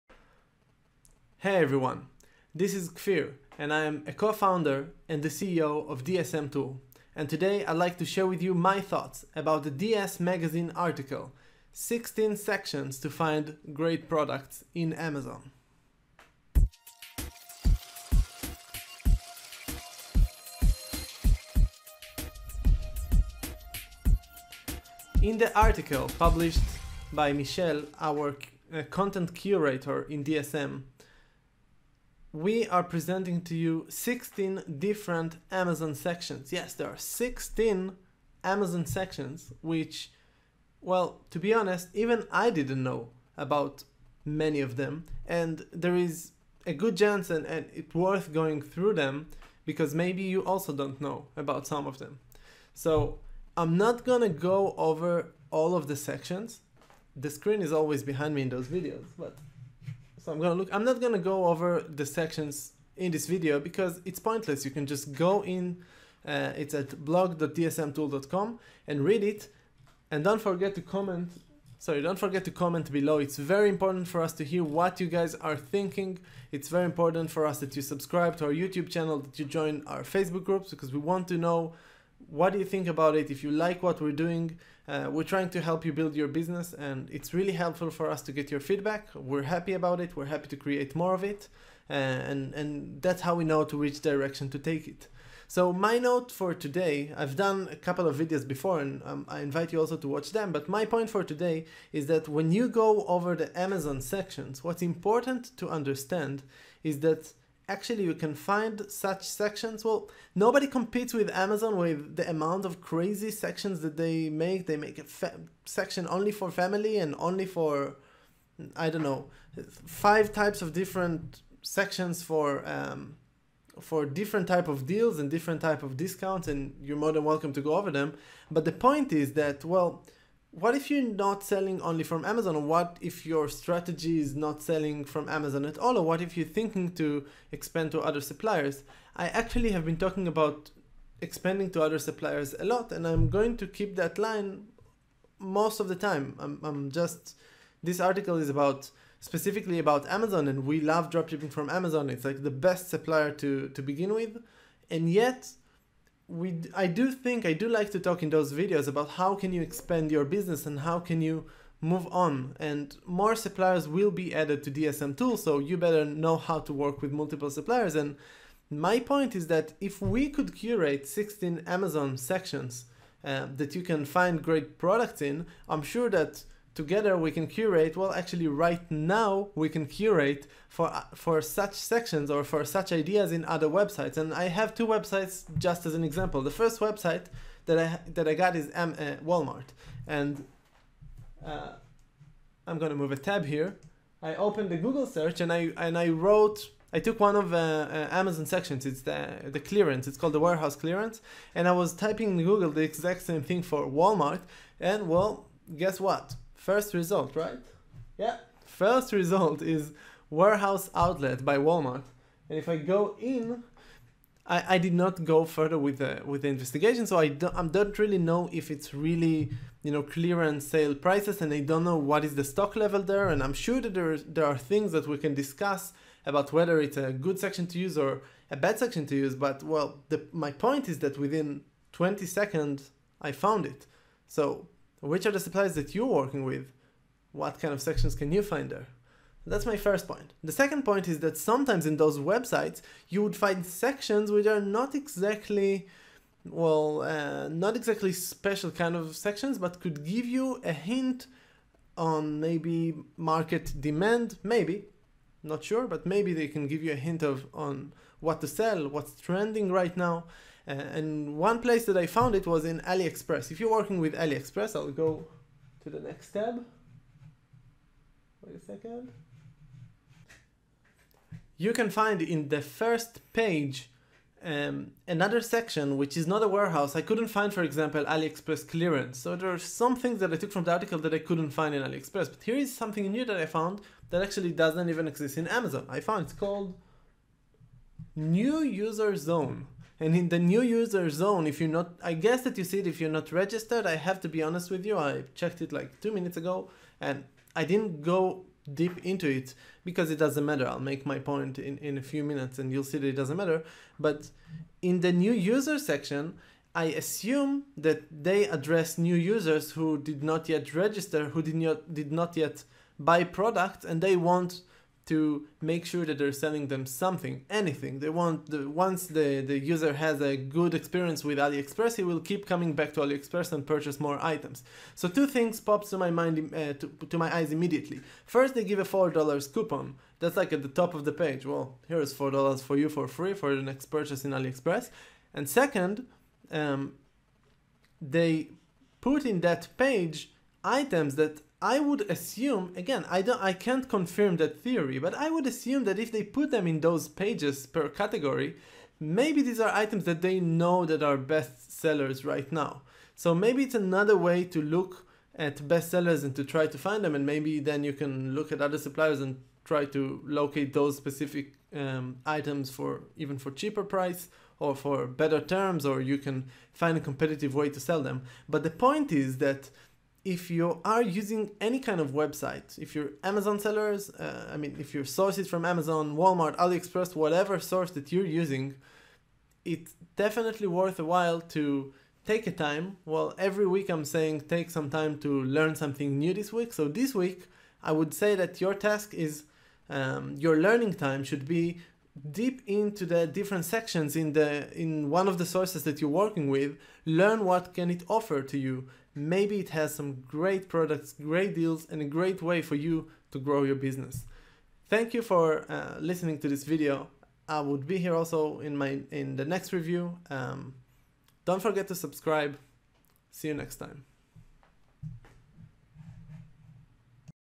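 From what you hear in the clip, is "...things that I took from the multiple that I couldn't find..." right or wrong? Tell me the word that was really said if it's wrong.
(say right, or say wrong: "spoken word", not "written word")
wrong: "article", not "multiple".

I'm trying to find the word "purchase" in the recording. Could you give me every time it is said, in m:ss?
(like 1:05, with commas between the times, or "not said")
5:23, 5:33.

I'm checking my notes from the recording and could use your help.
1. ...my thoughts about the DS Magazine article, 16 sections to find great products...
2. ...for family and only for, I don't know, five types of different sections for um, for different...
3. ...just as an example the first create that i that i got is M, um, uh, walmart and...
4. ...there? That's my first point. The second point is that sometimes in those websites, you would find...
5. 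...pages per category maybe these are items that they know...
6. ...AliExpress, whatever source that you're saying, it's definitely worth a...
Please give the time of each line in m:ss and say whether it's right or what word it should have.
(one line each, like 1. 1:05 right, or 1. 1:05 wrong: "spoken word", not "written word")
1. 0:08 right
2. 1:56 right
3. 3:05 wrong: "website", not "create"
4. 3:58 right
5. 5:47 right
6. 6:16 wrong: "using", not "saying".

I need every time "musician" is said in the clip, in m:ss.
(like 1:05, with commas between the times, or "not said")
not said.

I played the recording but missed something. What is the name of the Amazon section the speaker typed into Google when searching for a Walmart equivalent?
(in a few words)
Warehouse clearance.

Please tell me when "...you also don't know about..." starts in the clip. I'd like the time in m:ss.
0:50.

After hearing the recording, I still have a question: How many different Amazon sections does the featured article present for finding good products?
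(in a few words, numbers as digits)
16.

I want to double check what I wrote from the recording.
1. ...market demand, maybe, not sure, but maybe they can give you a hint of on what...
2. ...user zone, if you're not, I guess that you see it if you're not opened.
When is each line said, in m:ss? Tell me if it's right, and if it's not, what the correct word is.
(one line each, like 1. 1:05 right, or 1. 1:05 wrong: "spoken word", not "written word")
1. 4:13 right
2. 4:50 wrong: "registered", not "opened".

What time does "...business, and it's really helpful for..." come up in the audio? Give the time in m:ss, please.
1:26.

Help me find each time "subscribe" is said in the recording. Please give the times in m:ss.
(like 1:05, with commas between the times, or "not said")
1:17, 6:51.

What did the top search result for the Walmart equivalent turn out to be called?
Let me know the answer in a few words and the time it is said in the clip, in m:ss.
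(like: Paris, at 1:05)
Warehouse outlet, at 3:30.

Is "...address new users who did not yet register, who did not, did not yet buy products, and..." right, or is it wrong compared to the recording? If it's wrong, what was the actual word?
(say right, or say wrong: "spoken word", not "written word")
right.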